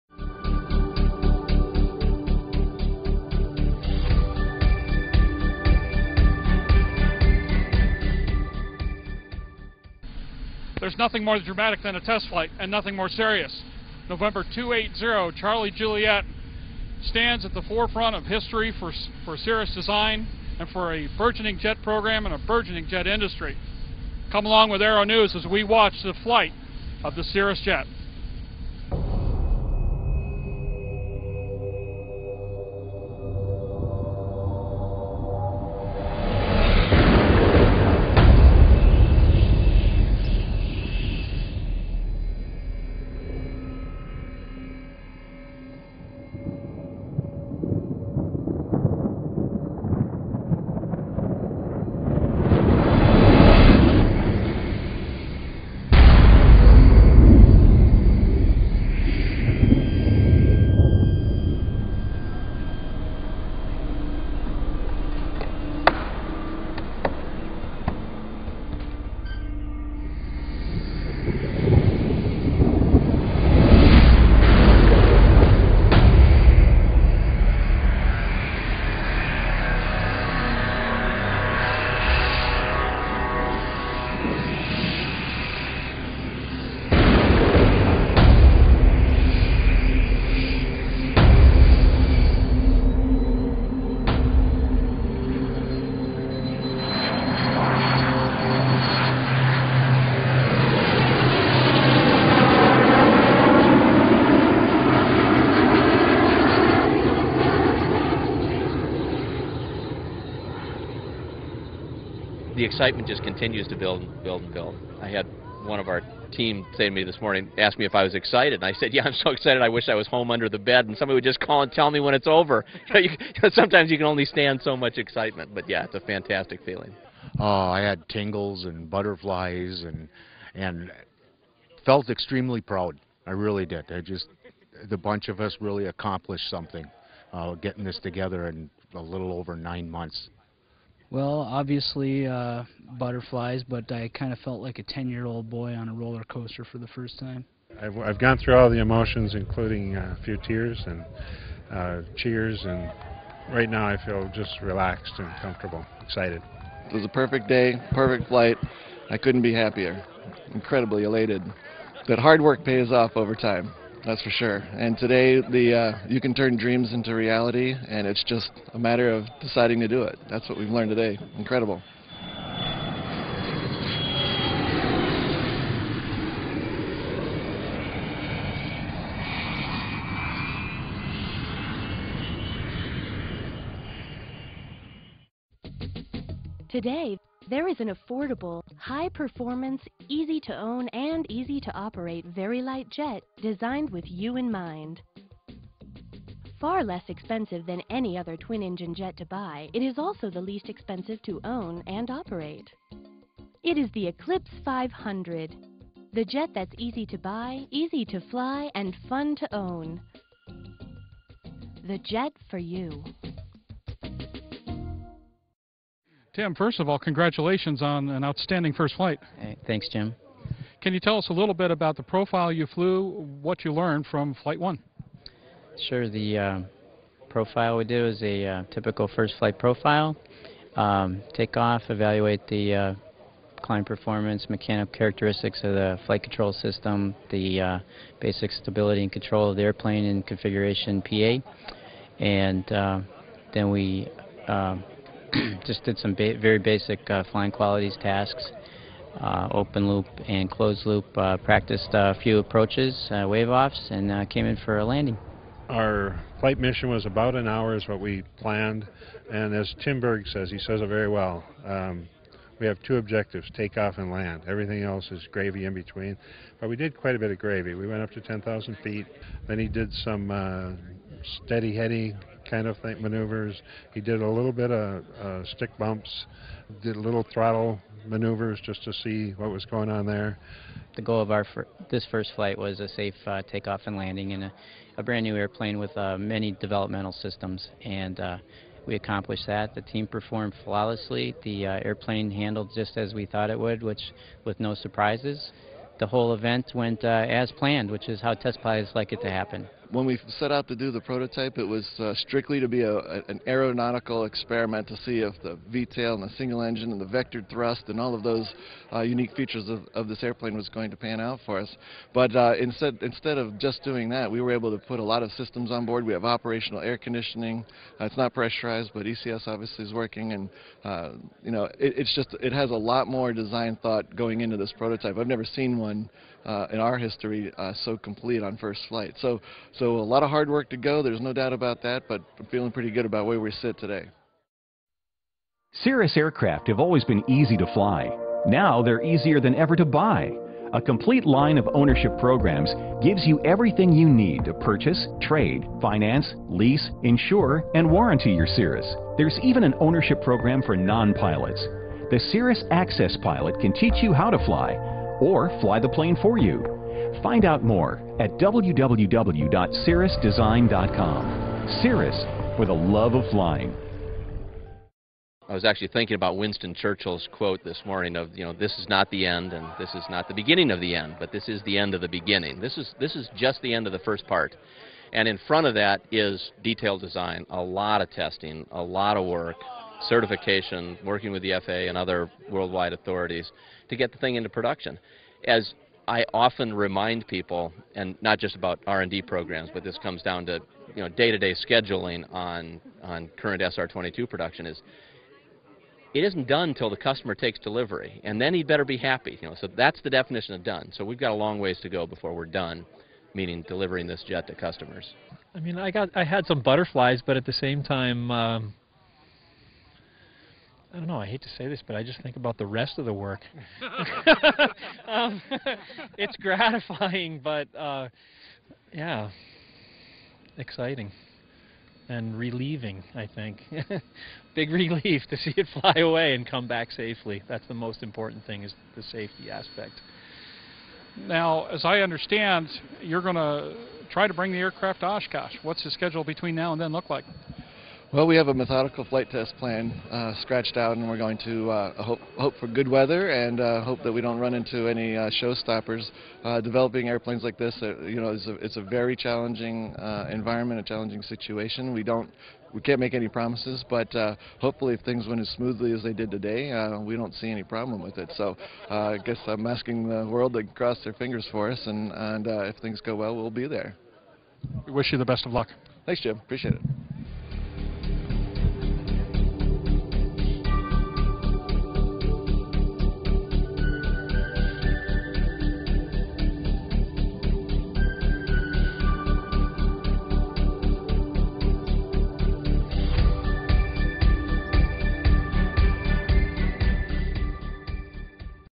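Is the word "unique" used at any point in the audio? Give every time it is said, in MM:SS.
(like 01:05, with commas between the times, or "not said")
05:09.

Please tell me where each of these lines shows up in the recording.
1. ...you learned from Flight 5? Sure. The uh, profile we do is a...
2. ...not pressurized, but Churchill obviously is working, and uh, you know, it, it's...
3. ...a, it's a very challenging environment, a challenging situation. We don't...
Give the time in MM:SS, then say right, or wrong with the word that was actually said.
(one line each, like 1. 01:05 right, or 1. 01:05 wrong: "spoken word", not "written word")
1. 03:43 wrong: "1", not "5"
2. 05:18 wrong: "ECS", not "Churchill"
3. 07:28 right.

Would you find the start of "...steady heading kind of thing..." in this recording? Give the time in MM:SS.
04:31.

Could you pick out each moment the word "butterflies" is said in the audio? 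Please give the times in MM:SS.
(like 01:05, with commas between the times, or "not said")
02:08, 02:22, 06:46.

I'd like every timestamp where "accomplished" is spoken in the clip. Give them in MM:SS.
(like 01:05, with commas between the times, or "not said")
02:15, 04:48.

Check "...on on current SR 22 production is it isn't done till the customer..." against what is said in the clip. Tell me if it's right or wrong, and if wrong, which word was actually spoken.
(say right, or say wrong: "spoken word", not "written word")
right.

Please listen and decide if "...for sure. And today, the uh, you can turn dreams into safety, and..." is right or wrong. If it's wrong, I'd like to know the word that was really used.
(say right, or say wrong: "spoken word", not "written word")
wrong: "reality", not "safety".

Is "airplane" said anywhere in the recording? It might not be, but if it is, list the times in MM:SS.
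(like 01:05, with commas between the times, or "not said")
03:59, 04:45, 04:51, 05:10, 07:27.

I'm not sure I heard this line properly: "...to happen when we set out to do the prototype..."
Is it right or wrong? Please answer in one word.
right.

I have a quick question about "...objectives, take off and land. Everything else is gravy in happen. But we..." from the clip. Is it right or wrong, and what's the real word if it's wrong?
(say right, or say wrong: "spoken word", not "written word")
wrong: "between", not "happen".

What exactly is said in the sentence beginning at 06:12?
This is this is just the end of the first part.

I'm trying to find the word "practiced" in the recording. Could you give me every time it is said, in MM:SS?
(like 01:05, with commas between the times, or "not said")
04:11.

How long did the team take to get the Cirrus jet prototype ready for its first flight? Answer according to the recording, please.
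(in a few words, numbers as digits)
a little over nine months.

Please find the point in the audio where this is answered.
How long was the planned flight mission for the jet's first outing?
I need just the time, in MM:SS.
04:17.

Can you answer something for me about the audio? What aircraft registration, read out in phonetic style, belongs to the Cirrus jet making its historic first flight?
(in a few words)
N280CJ.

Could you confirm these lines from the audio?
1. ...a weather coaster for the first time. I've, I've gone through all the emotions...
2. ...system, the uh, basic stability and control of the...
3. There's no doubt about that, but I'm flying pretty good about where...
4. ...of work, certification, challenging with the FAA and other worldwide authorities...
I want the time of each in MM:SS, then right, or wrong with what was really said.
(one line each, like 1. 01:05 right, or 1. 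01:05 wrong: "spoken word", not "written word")
1. 02:25 wrong: "roller", not "weather"
2. 03:56 right
3. 05:31 wrong: "feeling", not "flying"
4. 06:19 wrong: "working", not "challenging".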